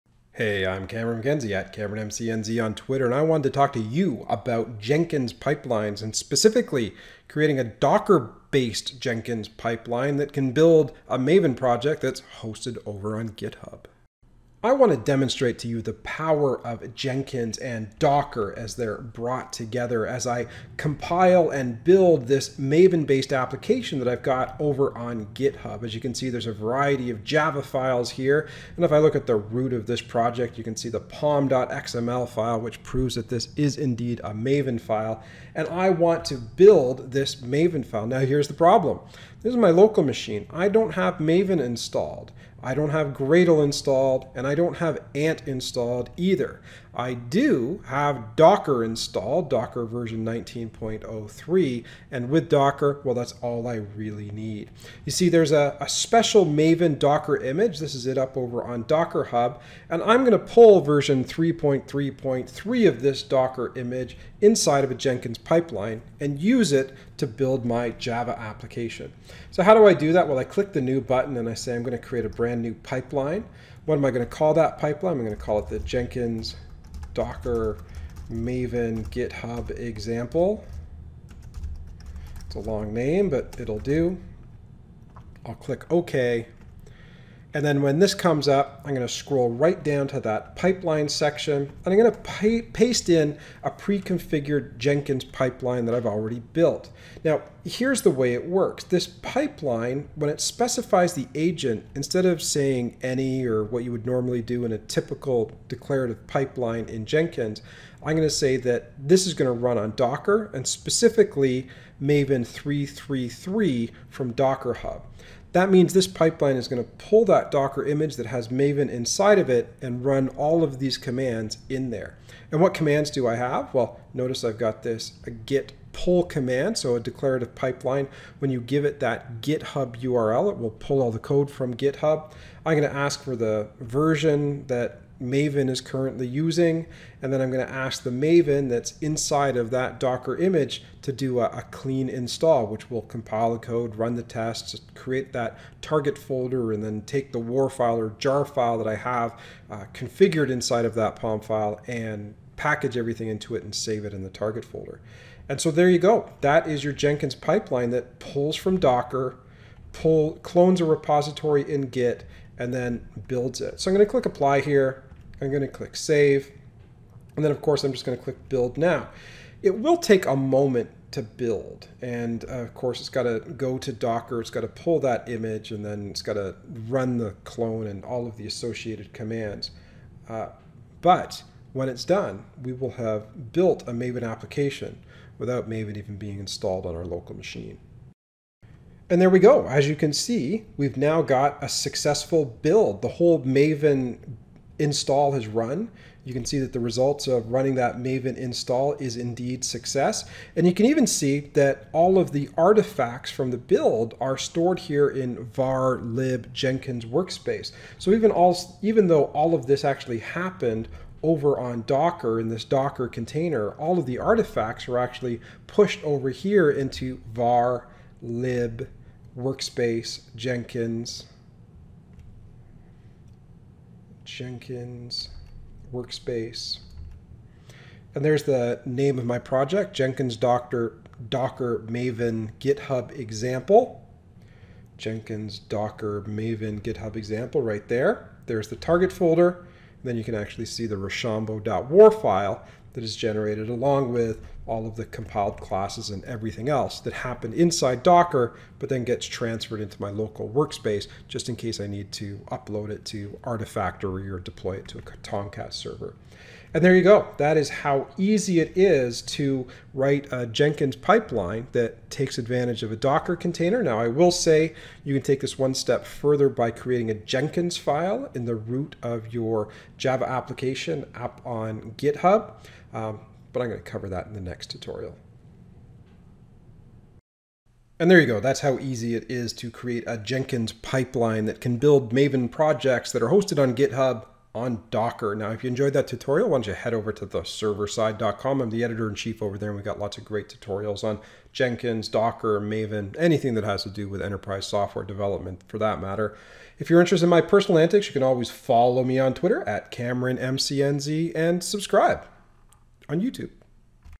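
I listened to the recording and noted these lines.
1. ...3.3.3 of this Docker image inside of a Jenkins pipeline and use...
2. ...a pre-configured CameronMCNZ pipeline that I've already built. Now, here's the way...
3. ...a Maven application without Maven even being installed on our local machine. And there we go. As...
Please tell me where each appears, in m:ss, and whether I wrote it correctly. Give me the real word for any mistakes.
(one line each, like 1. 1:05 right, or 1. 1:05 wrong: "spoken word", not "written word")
1. 1:01 right
2. 1:33 wrong: "Jenkins", not "CameronMCNZ"
3. 3:03 right.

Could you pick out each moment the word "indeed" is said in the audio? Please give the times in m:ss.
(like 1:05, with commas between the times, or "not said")
0:33, 3:19.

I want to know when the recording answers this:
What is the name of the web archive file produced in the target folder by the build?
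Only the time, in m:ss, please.
4:00.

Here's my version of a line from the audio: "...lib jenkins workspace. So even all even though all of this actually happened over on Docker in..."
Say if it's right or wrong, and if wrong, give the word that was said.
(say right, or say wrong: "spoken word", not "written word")
right.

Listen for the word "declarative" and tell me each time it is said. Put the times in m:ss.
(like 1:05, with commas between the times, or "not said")
1:45, 2:06.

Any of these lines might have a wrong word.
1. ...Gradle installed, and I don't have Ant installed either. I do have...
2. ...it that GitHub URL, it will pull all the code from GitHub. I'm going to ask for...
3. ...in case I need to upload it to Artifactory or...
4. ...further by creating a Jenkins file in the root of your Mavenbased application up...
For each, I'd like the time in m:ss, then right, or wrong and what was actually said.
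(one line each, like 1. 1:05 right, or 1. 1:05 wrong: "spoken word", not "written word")
1. 0:43 right
2. 2:08 right
3. 4:11 right
4. 4:26 wrong: "Java", not "Mavenbased".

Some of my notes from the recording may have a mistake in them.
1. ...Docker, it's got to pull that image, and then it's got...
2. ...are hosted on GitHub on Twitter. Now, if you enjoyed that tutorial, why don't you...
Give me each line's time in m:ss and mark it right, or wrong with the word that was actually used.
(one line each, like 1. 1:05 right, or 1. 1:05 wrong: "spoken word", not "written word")
1. 2:53 right
2. 4:43 wrong: "Docker", not "Twitter".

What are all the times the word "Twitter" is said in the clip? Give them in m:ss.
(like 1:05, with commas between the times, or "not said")
0:02, 4:59.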